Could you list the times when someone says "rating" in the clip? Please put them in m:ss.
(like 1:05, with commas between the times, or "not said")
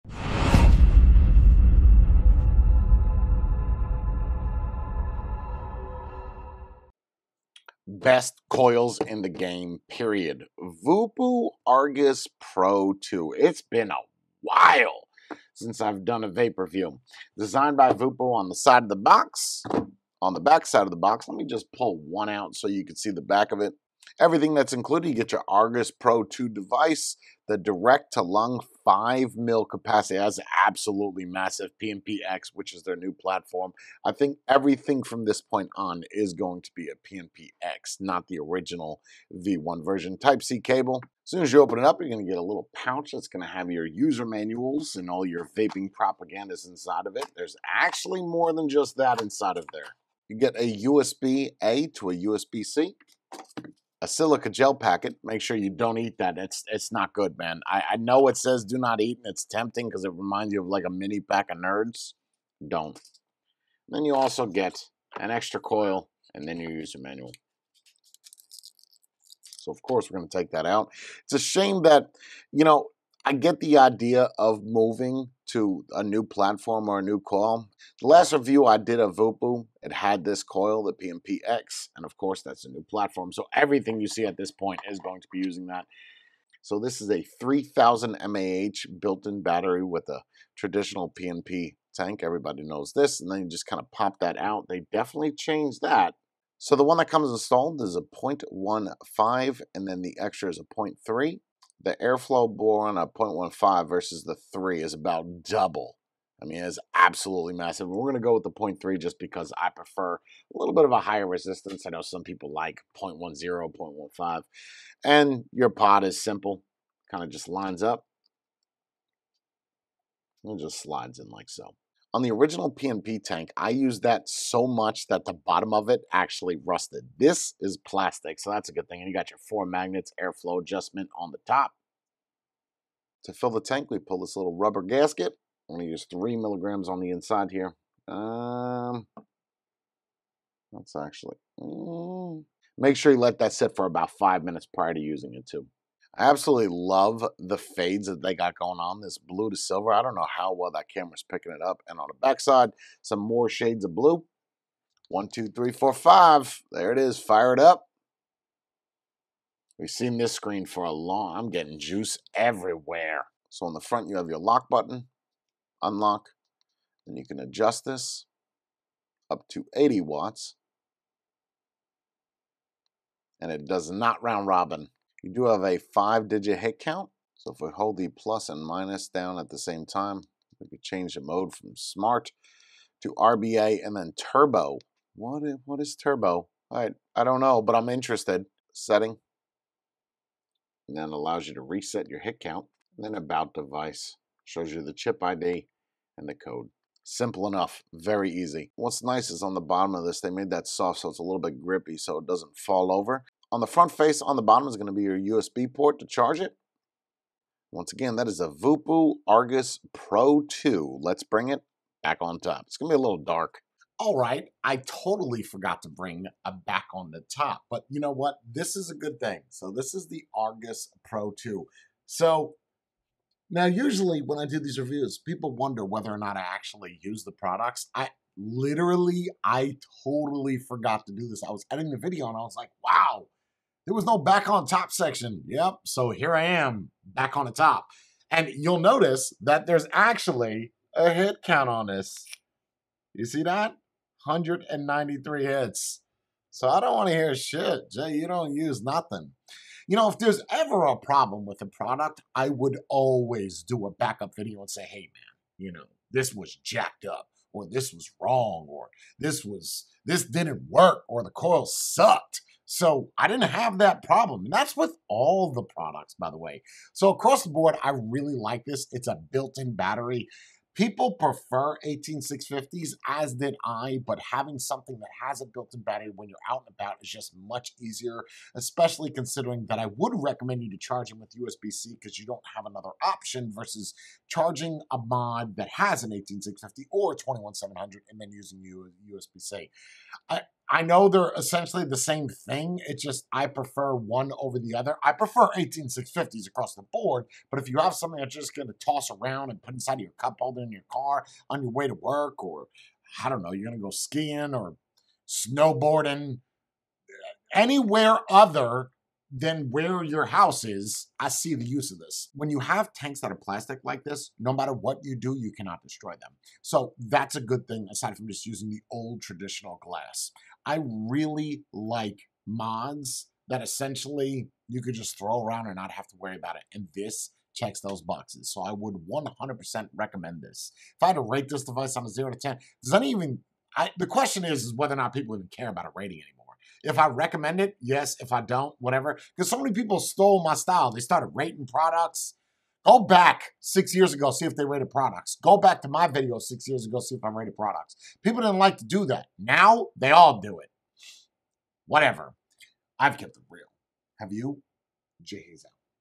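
5:35, 5:41.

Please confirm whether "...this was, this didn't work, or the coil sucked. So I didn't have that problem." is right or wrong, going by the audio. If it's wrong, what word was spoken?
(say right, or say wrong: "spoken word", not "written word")
right.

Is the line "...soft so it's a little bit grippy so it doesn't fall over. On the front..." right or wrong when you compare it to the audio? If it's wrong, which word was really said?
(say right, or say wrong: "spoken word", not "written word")
right.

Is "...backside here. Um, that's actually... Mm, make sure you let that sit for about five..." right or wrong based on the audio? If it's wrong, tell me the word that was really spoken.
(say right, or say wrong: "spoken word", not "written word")
wrong: "inside", not "backside".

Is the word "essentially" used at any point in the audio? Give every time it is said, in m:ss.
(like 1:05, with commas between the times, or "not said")
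4:51, 5:23.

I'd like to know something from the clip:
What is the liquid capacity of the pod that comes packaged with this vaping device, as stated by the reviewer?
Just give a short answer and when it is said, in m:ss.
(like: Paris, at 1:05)
5 ml, at 0:28.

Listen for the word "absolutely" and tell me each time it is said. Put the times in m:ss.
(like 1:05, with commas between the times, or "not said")
0:30, 1:46, 2:26.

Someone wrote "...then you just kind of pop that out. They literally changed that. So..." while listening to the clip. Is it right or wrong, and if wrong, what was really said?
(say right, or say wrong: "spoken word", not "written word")
wrong: "definitely", not "literally".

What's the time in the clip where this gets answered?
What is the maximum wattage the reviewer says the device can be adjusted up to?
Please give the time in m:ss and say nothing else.
2:49.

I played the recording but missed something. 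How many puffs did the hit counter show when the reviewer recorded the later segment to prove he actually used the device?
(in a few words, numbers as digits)
193.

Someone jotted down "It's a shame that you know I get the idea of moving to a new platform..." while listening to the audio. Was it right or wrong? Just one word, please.
right.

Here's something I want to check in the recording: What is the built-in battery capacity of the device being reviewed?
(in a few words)
3000 mAh.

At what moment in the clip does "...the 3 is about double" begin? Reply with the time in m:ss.
1:44.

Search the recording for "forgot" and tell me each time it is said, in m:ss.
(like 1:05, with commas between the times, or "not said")
3:35, 3:50.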